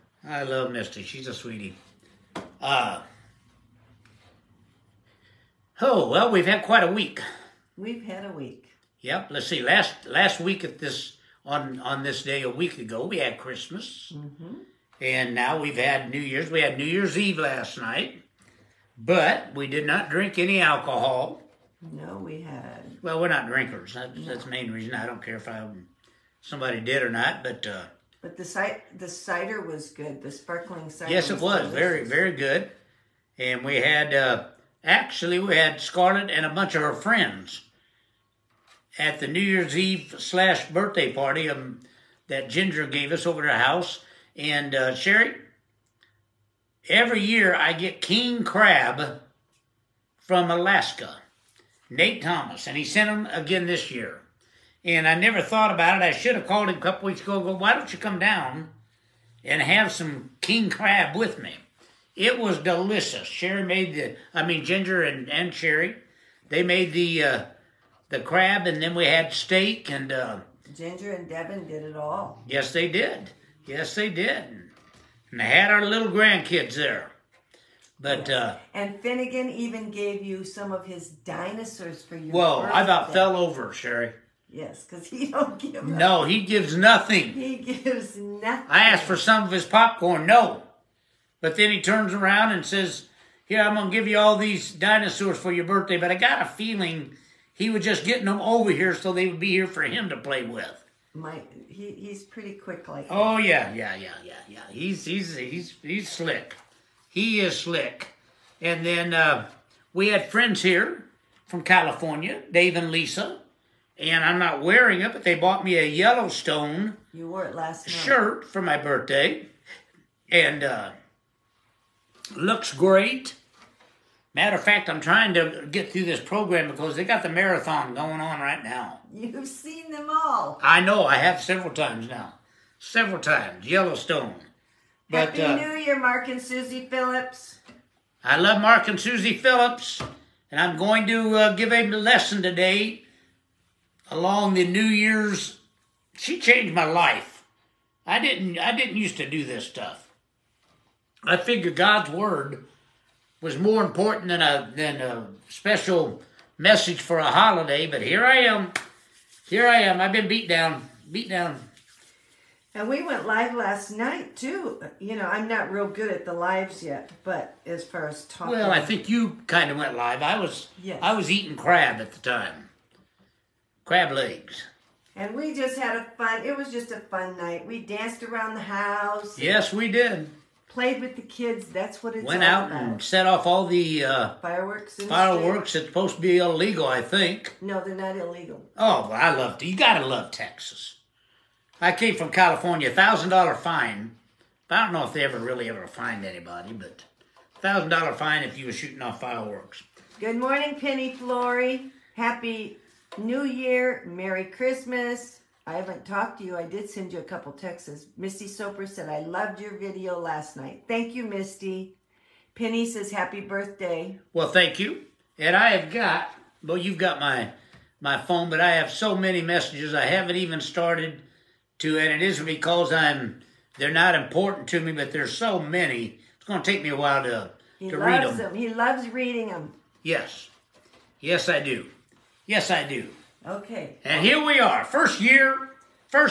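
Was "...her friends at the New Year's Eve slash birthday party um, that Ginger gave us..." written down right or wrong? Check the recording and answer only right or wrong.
right.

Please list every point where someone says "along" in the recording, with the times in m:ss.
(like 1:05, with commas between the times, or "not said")
2:24.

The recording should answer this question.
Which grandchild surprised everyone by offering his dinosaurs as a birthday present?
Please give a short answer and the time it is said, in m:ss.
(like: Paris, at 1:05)
Finnegan, at 1:19.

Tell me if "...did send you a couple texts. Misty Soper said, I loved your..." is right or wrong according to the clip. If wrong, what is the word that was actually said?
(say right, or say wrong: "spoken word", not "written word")
right.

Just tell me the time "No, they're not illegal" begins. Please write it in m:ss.
3:07.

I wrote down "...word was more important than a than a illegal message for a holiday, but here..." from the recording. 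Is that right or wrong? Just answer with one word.
wrong.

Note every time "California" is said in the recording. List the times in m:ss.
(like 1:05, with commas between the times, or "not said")
1:51, 3:12.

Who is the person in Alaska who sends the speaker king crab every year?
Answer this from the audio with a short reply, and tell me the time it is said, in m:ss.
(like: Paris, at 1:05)
Nate Thomas, at 0:51.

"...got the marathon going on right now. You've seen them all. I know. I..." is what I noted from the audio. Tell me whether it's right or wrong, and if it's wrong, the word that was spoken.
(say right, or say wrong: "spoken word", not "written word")
right.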